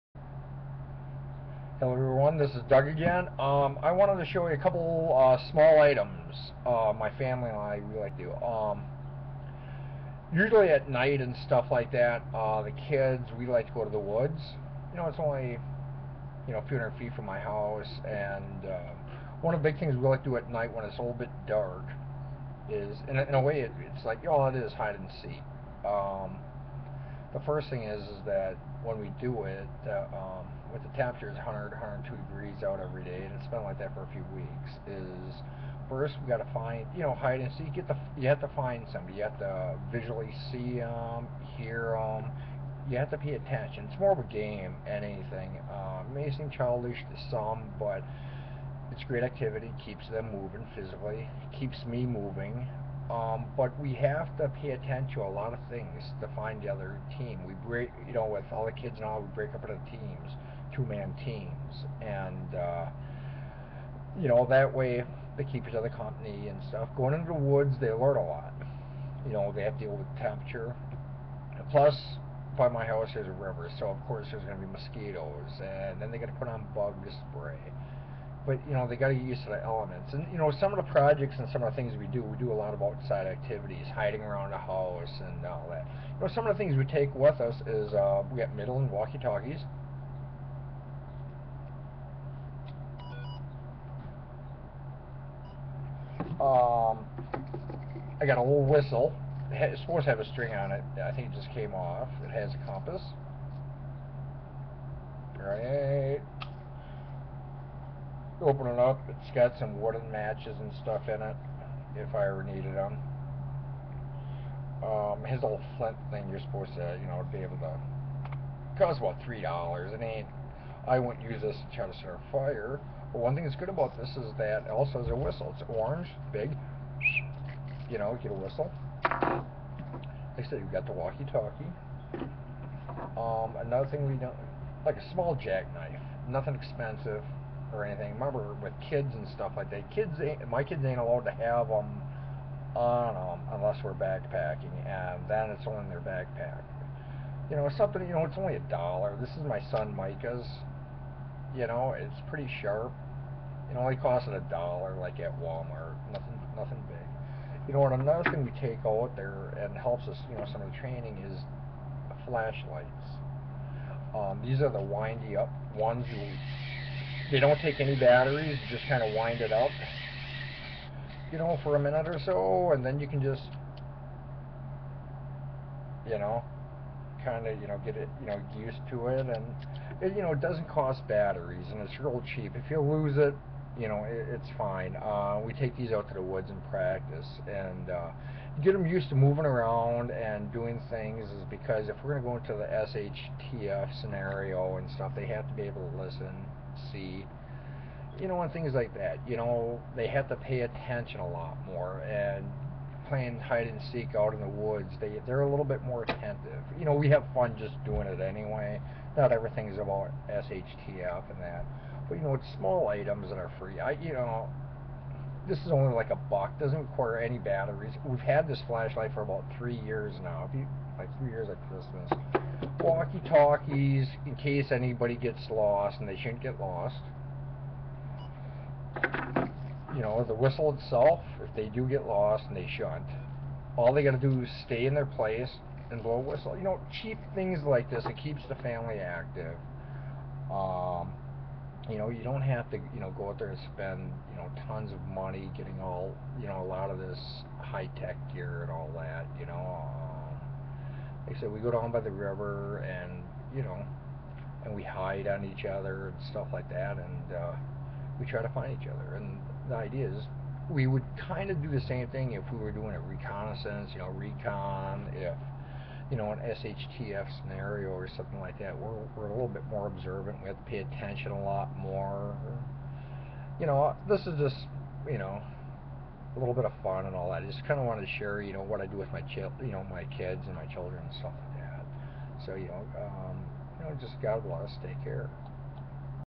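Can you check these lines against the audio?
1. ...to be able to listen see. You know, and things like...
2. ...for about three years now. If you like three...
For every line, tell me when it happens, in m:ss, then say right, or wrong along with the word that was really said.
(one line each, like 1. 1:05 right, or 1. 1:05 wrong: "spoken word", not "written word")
1. 3:15 right
2. 3:39 right.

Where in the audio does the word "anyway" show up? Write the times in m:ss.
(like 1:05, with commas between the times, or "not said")
3:28.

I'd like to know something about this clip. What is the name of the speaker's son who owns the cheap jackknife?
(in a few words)
Micah.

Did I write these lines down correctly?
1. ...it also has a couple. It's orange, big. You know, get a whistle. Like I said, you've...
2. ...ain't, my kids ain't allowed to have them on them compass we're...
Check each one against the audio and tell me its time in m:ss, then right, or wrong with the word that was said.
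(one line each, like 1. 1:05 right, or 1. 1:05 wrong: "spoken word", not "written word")
1. 2:04 wrong: "whistle", not "couple"
2. 2:20 wrong: "unless", not "compass".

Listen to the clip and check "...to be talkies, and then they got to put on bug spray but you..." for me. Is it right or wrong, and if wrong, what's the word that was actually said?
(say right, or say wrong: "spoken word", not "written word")
wrong: "mosquitoes", not "talkies".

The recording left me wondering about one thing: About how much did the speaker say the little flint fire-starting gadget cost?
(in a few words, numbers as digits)
$3.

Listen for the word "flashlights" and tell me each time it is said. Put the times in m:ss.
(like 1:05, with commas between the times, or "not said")
2:42, 3:38.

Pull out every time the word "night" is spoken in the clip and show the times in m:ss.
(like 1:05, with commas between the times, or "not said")
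0:10, 0:20.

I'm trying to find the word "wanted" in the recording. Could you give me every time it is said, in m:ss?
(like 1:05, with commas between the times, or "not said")
0:03, 4:37.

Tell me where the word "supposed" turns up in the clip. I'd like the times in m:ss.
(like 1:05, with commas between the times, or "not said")
1:39, 1:56.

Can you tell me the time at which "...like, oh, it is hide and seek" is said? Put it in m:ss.
0:24.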